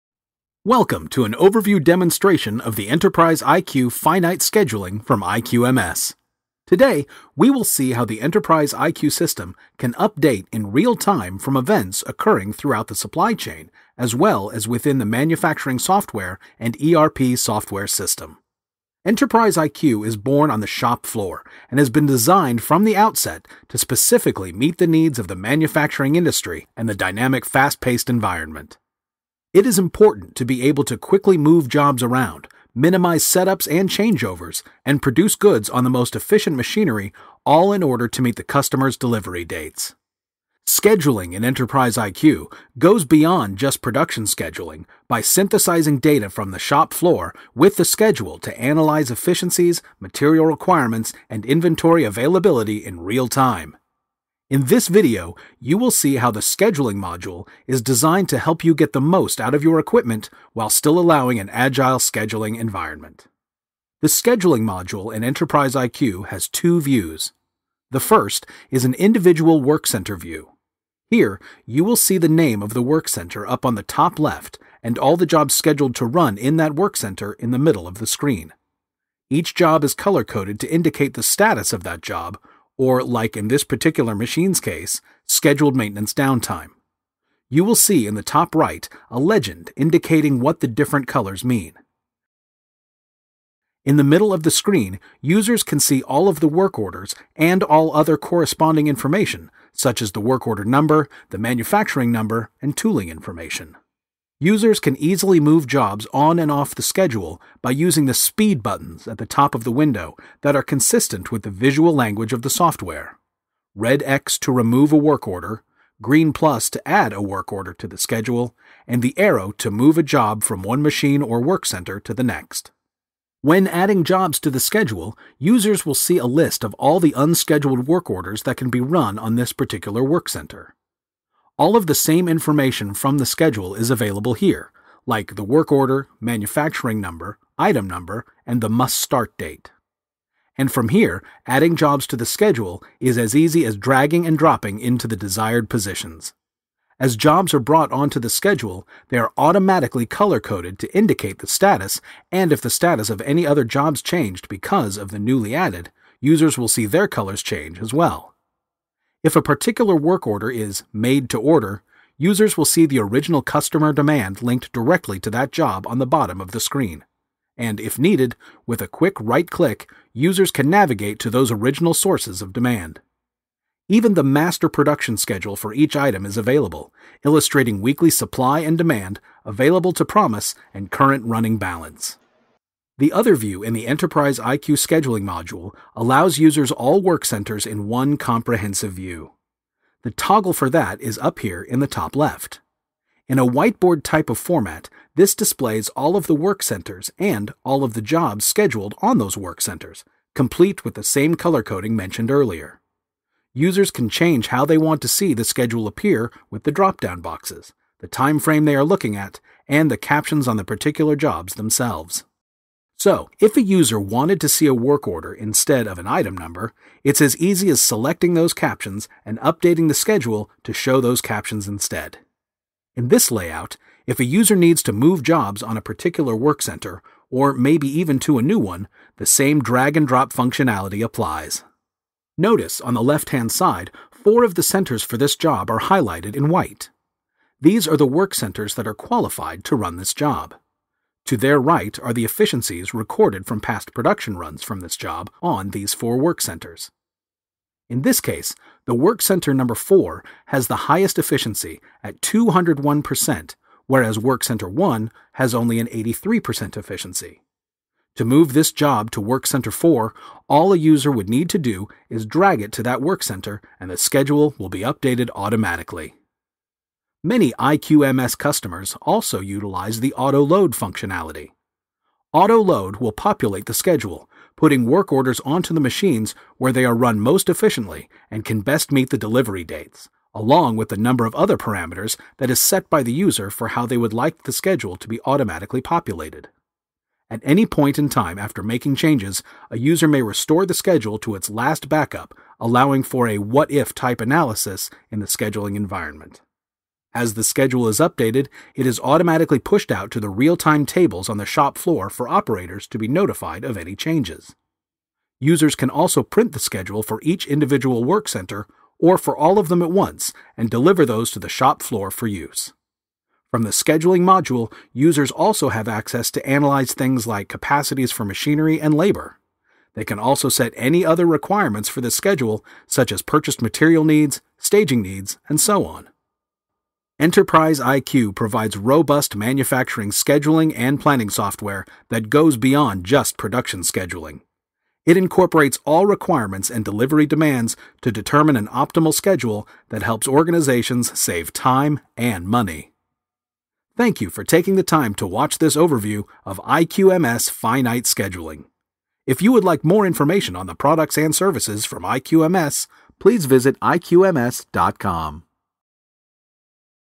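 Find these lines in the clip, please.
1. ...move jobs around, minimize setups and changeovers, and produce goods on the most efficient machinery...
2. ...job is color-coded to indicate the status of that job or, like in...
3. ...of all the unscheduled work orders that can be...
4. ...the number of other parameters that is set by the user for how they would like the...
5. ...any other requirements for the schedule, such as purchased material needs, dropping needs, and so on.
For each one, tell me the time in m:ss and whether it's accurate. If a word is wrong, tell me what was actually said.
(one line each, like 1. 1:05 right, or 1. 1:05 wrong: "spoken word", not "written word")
1. 0:31 right
2. 1:19 right
3. 2:06 right
4. 4:40 right
5. 5:20 wrong: "staging", not "dropping".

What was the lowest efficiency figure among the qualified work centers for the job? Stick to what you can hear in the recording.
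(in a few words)
83%.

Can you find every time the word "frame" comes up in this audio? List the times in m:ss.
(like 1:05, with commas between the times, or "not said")
3:28.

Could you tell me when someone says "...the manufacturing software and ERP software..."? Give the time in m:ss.
0:14.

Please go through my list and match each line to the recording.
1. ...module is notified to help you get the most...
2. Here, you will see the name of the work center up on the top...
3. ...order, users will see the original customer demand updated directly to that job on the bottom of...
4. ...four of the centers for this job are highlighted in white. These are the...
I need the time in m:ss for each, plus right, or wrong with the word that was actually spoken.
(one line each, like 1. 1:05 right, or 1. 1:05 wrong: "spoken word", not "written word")
1. 0:56 wrong: "designed", not "notified"
2. 1:11 right
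3. 2:41 wrong: "linked", not "updated"
4. 3:54 right.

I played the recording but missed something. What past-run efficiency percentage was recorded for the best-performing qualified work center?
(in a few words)
201%.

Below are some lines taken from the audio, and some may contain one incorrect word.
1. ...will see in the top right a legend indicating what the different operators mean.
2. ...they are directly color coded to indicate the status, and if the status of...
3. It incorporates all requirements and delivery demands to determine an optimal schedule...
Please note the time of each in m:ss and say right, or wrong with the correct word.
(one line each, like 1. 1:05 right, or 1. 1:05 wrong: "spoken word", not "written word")
1. 1:27 wrong: "colors", not "operators"
2. 2:29 wrong: "automatically", not "directly"
3. 5:35 right.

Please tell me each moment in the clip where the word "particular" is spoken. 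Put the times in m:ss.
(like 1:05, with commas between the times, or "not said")
1:23, 2:09, 2:39, 3:30, 3:45.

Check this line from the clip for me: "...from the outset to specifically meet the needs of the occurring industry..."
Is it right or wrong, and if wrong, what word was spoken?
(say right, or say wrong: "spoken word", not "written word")
wrong: "manufacturing", not "occurring".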